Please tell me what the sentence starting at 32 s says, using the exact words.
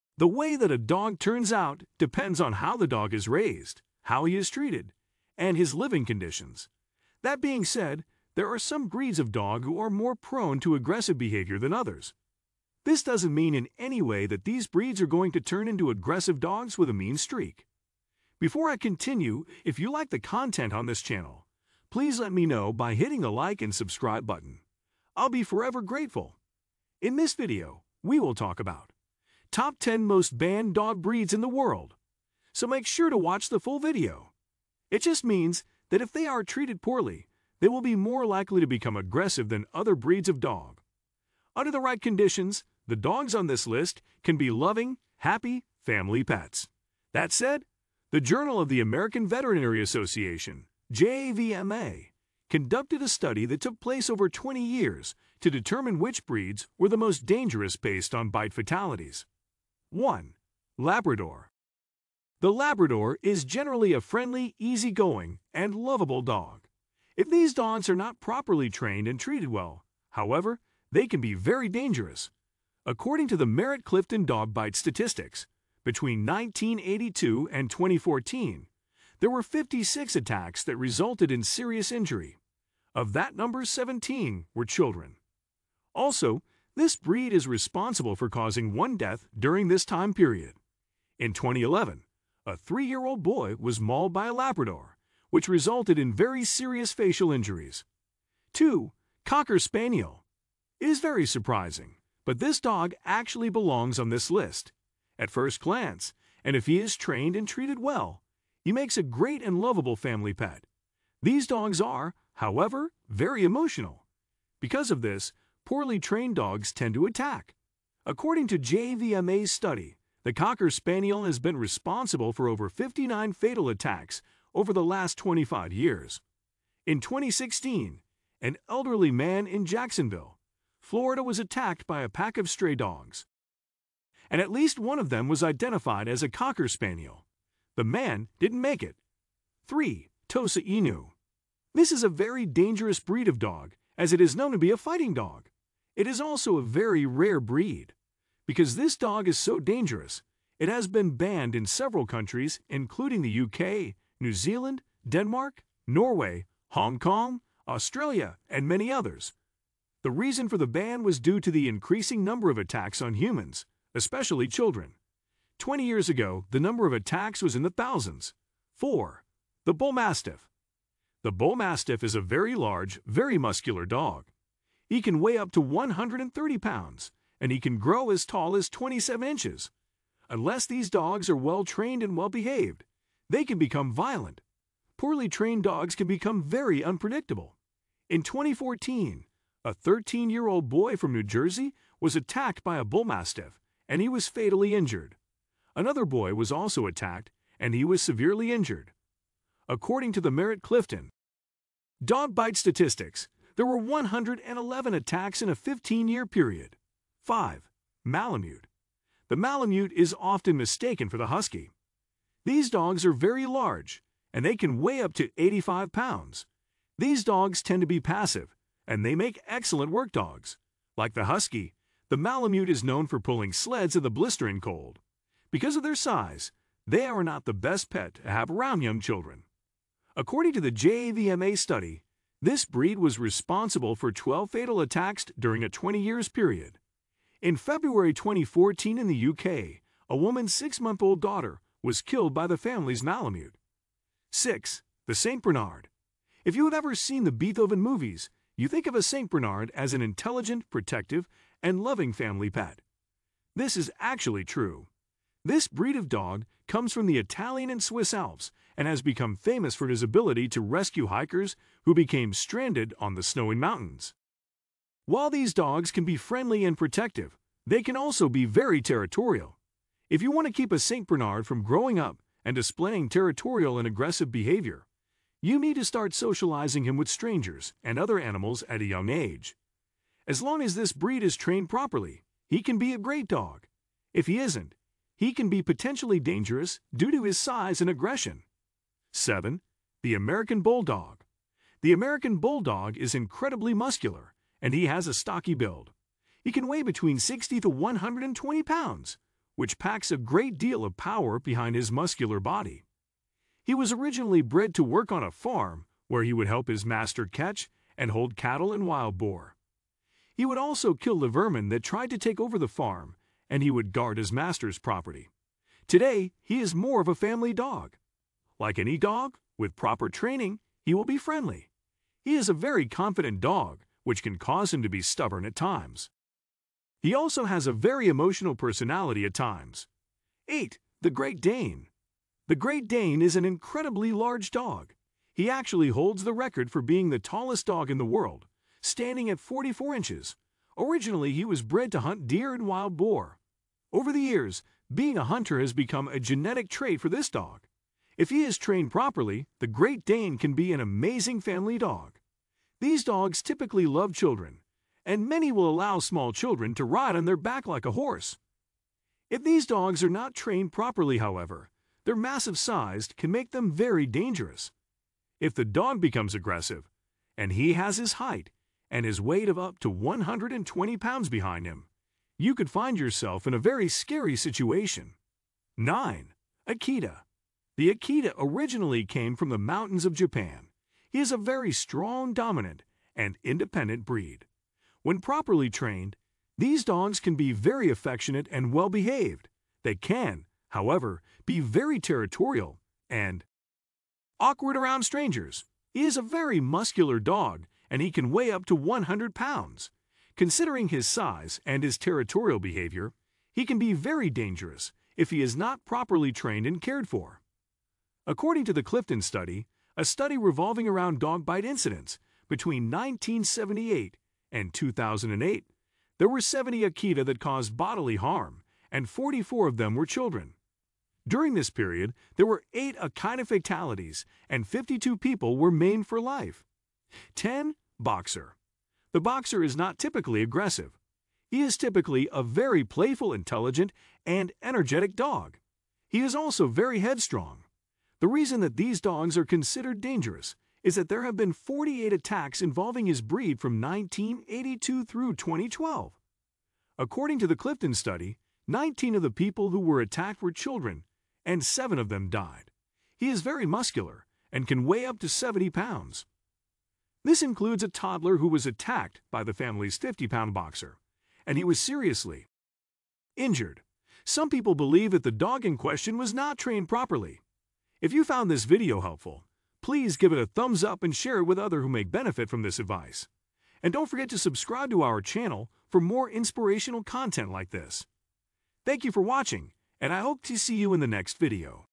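So make sure to watch the full video.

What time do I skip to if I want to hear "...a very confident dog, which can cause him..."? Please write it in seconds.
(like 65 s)
322 s.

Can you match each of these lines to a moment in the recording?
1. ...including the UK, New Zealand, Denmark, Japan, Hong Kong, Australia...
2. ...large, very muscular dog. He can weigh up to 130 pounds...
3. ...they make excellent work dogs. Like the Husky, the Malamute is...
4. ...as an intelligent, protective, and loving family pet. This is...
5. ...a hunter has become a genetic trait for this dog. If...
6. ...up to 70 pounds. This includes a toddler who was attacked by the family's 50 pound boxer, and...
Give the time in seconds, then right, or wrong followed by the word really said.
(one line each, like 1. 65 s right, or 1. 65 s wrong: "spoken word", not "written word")
1. 152 s wrong: "Norway", not "Japan"
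2. 172 s right
3. 219 s right
4. 249 s right
5. 345 s right
6. 455 s right.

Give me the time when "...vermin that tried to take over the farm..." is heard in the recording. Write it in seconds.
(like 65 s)
311 s.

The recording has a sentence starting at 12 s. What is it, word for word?
This doesn't mean in any way that these breeds are going to turn into aggressive dogs with a mean streak.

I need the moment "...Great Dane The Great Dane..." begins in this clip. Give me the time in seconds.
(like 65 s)
331 s.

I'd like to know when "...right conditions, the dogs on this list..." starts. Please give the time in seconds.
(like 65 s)
41 s.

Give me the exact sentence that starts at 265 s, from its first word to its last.
While these dogs can be friendly and protective, they can also be very territorial.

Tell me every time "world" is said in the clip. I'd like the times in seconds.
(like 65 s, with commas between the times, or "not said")
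31 s, 338 s.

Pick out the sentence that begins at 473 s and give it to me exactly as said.
And don't forget to subscribe to our channel for more inspirational content like this.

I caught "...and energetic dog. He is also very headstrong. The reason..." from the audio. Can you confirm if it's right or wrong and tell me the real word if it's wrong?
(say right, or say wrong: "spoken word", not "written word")
right.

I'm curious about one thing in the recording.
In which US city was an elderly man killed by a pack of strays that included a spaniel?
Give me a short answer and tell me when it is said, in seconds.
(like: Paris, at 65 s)
Jacksonville, at 129 s.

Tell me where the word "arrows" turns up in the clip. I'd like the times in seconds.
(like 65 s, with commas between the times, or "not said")
not said.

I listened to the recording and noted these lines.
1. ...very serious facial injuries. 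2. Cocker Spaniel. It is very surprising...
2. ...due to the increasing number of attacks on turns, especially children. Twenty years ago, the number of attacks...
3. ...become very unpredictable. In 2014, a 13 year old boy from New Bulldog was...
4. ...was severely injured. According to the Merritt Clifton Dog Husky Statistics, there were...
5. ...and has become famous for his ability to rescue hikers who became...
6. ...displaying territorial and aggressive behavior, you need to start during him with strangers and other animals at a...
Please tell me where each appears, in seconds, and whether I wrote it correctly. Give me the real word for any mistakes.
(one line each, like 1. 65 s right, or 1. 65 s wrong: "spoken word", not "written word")
1. 96 s right
2. 161 s wrong: "humans", not "turns"
3. 186 s wrong: "Jersey", not "Bulldog"
4. 197 s wrong: "Bite", not "Husky"
5. 258 s right
6. 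272 s wrong: "socializing", not "during".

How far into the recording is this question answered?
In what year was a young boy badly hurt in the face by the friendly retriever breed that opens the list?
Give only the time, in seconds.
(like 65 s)
91 s.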